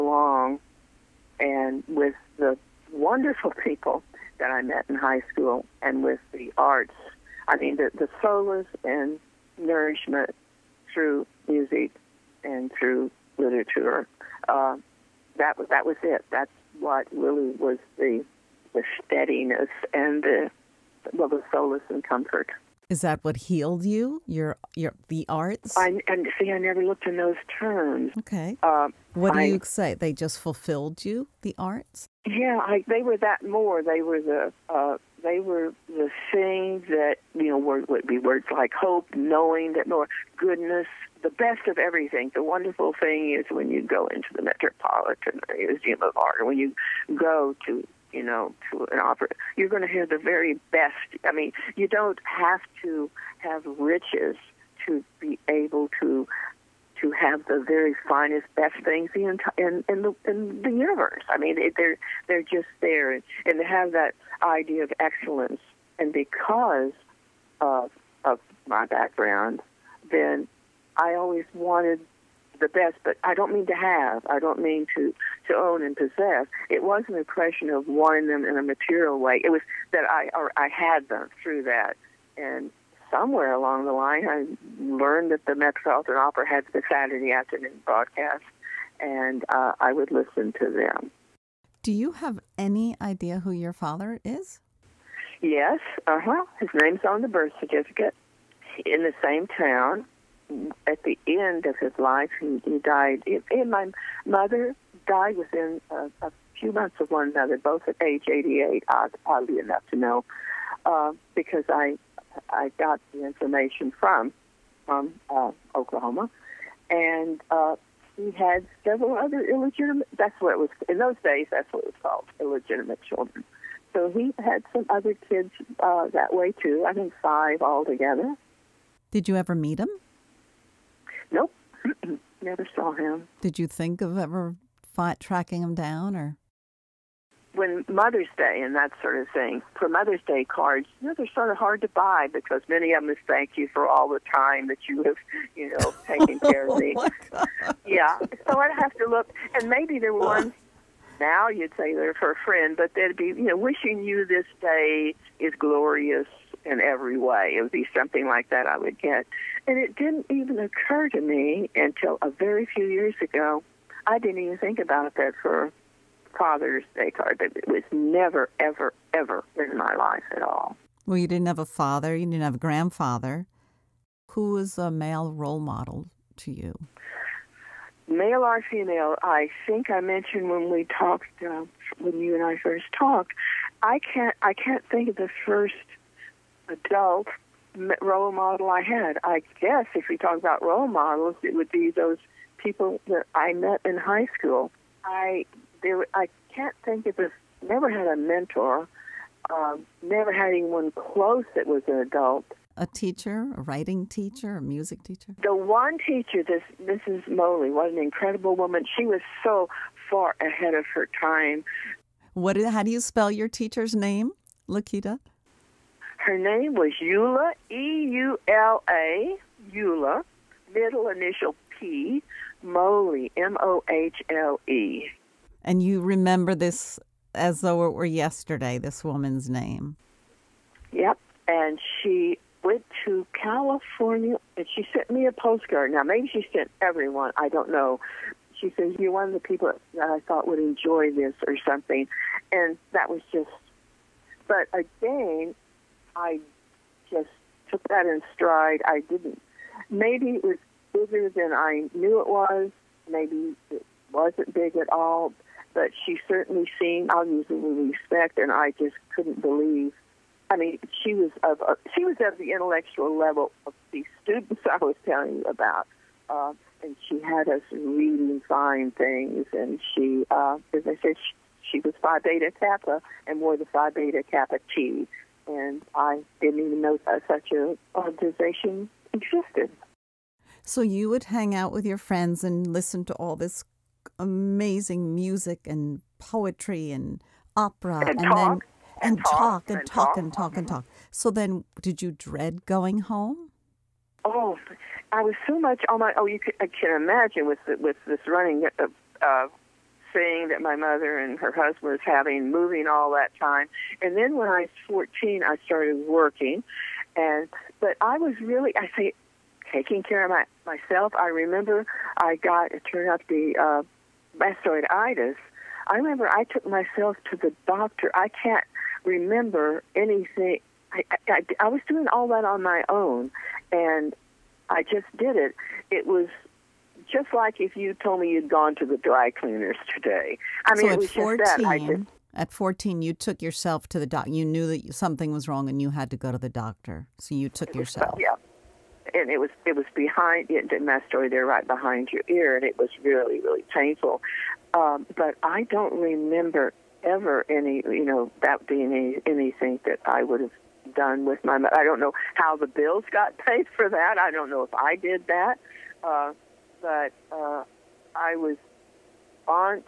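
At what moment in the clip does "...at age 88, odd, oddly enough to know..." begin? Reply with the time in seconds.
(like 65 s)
107 s.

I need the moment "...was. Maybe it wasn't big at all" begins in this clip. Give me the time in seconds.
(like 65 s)
252 s.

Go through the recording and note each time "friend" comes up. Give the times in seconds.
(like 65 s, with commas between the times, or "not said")
152 s, 281 s.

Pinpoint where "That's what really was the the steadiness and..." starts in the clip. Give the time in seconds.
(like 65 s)
16 s.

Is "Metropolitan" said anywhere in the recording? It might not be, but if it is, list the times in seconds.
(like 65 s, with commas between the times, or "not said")
44 s, 85 s.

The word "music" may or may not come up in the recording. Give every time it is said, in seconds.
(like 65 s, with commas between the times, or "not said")
11 s, 204 s, 285 s.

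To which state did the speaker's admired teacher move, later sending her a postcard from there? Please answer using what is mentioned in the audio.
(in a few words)
California.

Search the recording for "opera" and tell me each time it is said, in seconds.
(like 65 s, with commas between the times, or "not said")
48 s, 86 s, 287 s.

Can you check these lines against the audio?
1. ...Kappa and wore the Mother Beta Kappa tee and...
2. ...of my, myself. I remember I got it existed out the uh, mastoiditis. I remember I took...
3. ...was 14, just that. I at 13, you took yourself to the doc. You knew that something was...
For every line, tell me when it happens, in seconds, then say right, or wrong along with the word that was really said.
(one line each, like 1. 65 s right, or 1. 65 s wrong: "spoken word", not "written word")
1. 272 s wrong: "Phi", not "Mother"
2. 310 s wrong: "turned", not "existed"
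3. 330 s wrong: "14", not "13".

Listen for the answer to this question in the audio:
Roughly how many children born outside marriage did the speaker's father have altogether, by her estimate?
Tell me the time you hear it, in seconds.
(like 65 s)
127 s.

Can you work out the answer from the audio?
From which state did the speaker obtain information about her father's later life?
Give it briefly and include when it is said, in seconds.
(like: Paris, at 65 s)
Oklahoma, at 115 s.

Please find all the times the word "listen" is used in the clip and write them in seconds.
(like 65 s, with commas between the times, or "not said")
90 s, 282 s.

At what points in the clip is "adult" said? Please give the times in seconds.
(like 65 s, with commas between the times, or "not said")
186 s, 201 s.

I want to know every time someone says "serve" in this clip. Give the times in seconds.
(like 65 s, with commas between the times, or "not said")
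not said.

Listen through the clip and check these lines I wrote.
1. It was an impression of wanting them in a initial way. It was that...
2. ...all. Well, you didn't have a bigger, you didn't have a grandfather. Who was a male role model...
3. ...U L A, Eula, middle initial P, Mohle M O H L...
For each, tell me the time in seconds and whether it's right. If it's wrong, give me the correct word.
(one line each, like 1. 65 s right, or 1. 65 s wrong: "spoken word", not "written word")
1. 76 s wrong: "material", not "initial"
2. 170 s wrong: "father", not "bigger"
3. 218 s right.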